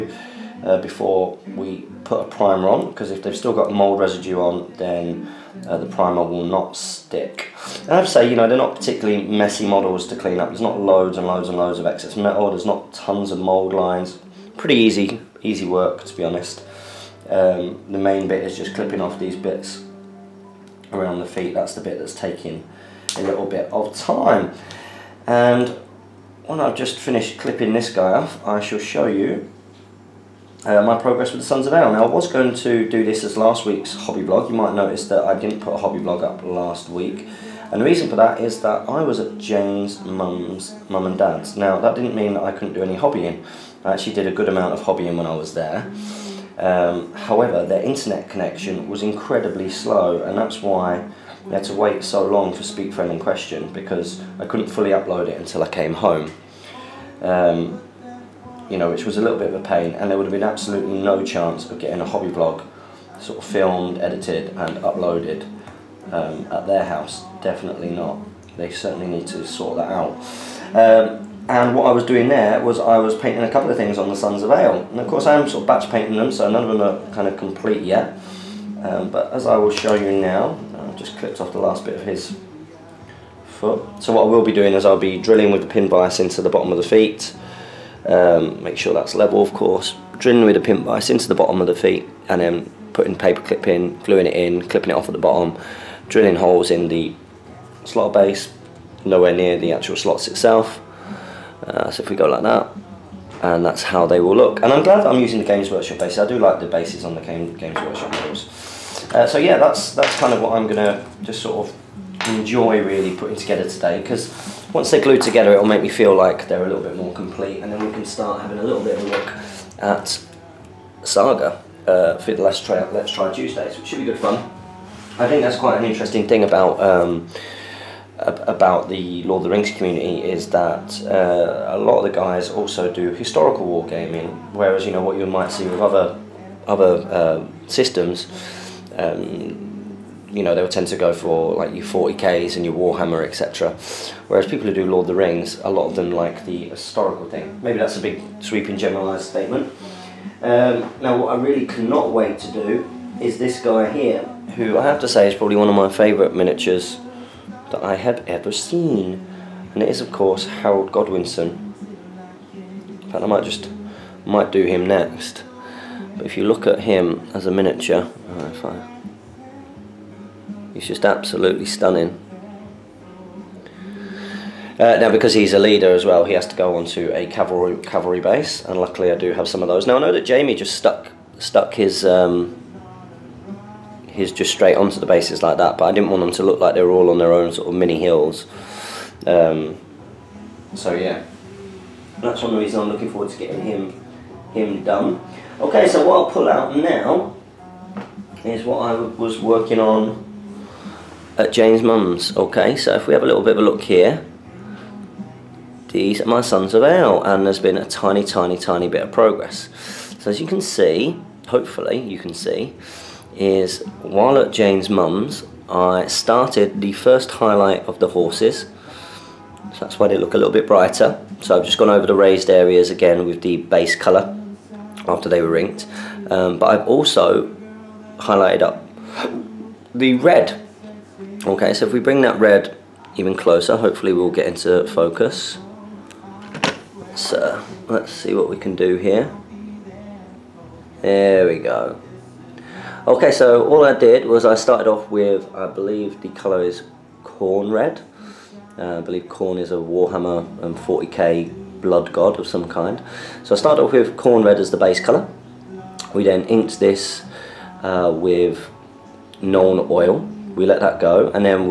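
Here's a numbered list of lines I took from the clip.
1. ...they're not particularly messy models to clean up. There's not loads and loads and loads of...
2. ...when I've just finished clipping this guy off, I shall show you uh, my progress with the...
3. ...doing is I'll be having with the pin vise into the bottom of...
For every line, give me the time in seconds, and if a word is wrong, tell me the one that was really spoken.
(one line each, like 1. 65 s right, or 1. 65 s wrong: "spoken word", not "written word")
1. 8 s right
2. 26 s right
3. 84 s wrong: "drilling", not "having".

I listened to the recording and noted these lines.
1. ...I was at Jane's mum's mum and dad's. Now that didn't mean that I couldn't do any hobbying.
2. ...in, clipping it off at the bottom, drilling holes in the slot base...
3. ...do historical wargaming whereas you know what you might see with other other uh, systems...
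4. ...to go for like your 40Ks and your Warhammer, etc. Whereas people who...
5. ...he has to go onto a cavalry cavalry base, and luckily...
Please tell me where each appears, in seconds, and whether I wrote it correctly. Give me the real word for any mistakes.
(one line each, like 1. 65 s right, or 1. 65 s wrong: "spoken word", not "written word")
1. 38 s right
2. 94 s right
3. 132 s right
4. 140 s right
5. 176 s right.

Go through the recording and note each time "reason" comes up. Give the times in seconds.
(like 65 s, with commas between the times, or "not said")
37 s, 192 s.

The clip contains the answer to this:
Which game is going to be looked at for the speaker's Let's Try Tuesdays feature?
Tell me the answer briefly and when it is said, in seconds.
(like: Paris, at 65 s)
Saga, at 121 s.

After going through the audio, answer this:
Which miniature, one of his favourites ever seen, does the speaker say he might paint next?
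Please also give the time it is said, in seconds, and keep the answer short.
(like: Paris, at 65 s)
Harold Godwinson, at 160 s.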